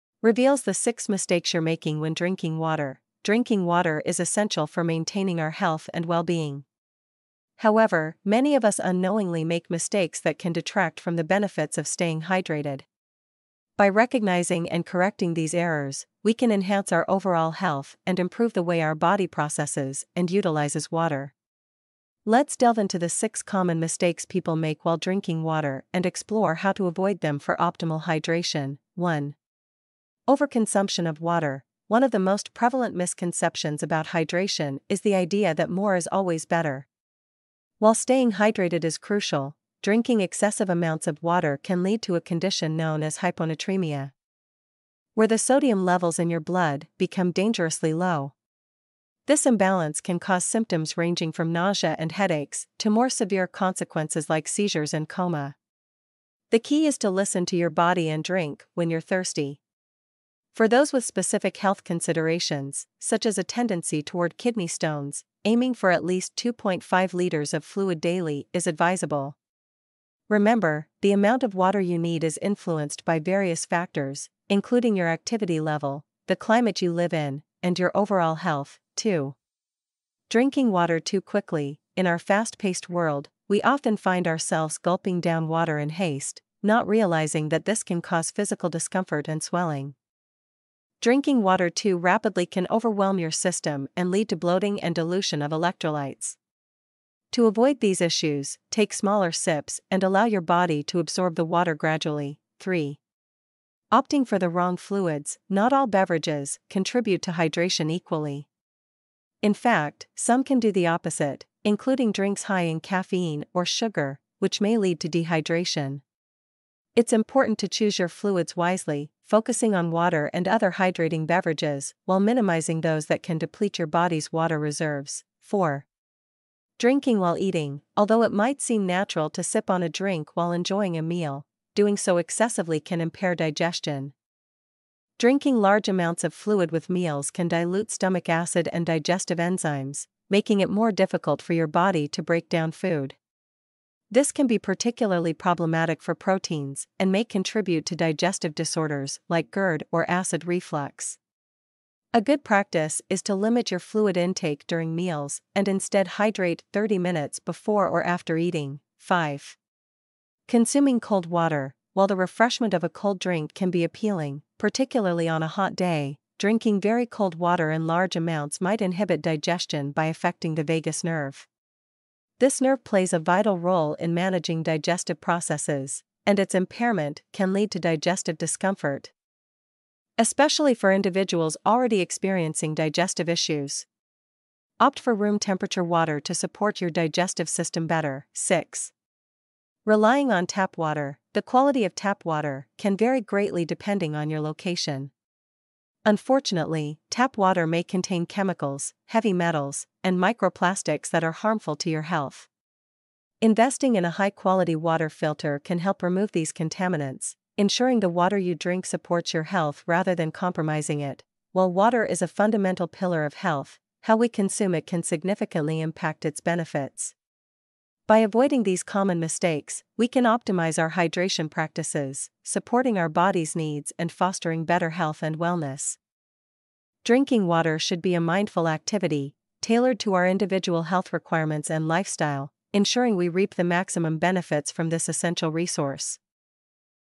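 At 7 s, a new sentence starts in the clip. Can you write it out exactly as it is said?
However, many of us unknowingly make mistakes that can detract from the benefits of staying hydrated.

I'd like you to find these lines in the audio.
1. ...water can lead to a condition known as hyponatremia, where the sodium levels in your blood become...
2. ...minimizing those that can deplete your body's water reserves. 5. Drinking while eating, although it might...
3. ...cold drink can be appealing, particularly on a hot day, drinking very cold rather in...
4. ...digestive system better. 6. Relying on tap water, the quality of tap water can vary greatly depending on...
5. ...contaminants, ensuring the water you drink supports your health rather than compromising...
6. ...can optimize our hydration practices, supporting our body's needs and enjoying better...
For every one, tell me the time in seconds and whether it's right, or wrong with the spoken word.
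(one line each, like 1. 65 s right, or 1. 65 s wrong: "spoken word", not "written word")
1. 41 s right
2. 122 s wrong: "4", not "5"
3. 162 s wrong: "water", not "rather"
4. 186 s right
5. 206 s right
6. 220 s wrong: "fostering", not "enjoying".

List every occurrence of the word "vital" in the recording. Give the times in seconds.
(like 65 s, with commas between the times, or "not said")
173 s.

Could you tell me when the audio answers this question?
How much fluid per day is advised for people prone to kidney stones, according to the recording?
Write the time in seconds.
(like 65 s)
66 s.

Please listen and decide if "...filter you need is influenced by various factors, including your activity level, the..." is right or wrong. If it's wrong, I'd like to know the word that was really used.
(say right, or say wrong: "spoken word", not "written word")
wrong: "water", not "filter".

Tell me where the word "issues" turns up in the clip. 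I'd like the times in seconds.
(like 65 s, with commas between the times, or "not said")
98 s, 183 s.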